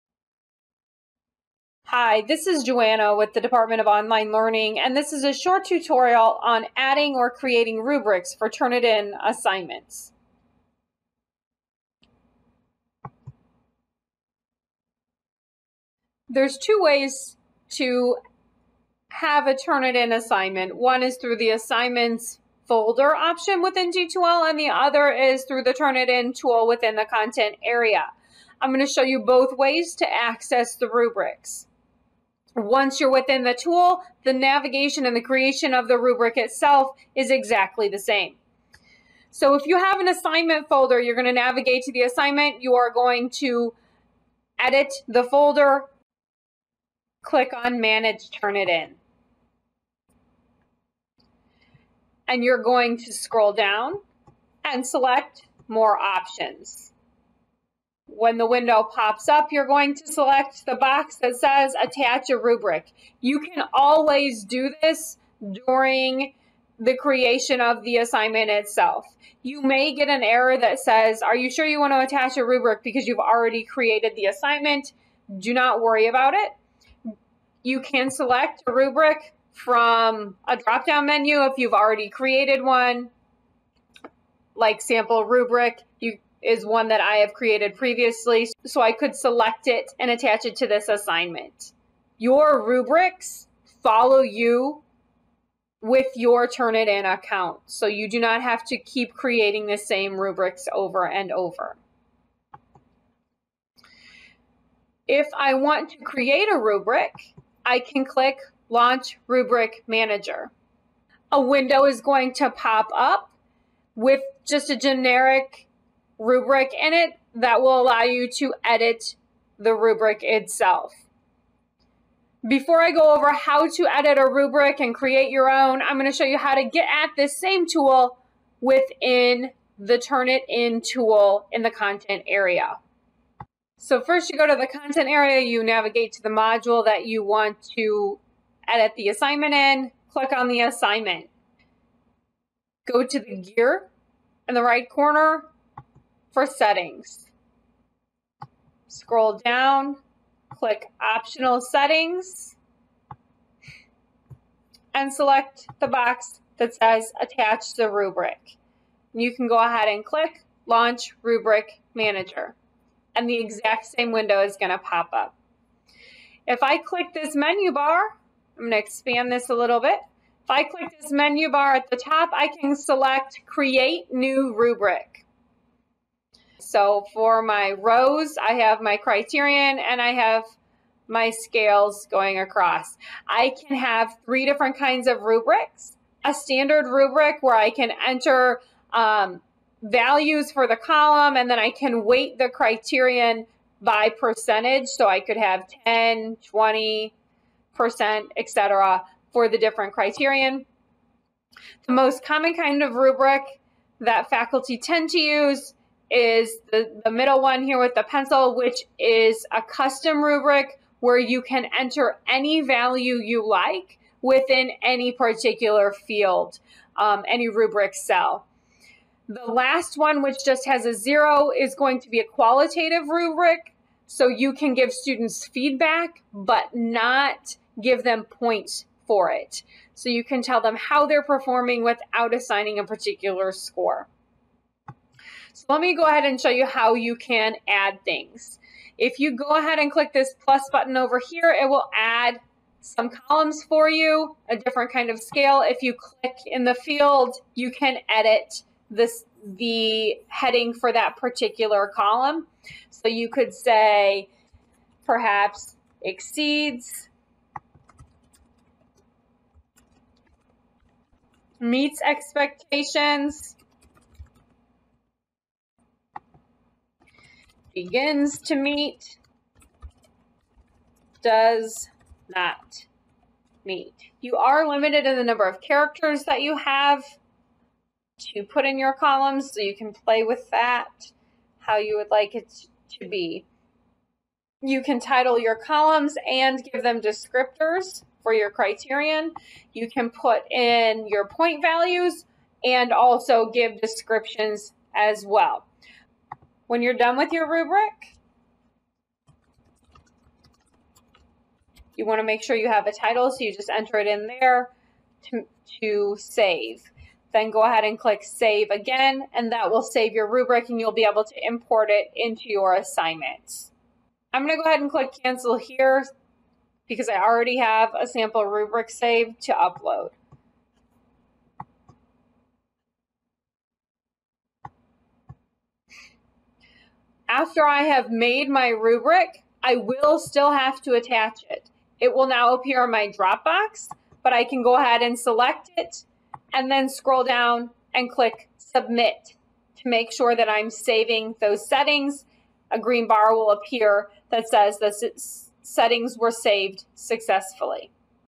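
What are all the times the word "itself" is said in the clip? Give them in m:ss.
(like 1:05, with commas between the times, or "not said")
0:36, 1:08, 2:00.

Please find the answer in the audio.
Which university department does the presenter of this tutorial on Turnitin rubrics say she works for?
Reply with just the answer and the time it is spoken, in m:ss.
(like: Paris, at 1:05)
Department of Online Learning, at 0:03.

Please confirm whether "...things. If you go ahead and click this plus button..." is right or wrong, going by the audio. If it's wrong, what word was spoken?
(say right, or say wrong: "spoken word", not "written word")
right.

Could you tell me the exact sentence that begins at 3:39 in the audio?
The last one, which just has a zero, is going to be a qualitative rubric.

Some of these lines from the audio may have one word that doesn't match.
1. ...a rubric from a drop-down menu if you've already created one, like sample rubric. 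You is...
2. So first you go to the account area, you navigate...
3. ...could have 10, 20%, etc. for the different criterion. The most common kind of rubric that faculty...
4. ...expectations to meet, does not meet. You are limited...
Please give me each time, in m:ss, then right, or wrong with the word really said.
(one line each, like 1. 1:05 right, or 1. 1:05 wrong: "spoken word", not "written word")
1. 1:18 right
2. 2:13 wrong: "content", not "account"
3. 3:15 right
4. 4:27 wrong: "begins", not "expectations".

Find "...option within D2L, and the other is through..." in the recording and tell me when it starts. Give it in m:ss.
0:23.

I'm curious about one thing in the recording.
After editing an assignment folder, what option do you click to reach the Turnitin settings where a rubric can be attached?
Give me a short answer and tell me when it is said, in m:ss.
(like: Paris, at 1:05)
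Manage Turnitin, at 0:47.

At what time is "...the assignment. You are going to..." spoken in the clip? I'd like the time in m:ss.
0:41.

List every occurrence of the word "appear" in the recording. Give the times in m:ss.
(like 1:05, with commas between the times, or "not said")
5:32, 5:43.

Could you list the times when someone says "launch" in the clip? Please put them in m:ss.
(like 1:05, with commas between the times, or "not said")
1:48, 2:40.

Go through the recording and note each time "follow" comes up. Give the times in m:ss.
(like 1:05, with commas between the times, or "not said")
1:33.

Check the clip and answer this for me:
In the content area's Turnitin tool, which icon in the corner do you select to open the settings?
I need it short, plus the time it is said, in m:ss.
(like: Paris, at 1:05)
the gear, at 2:23.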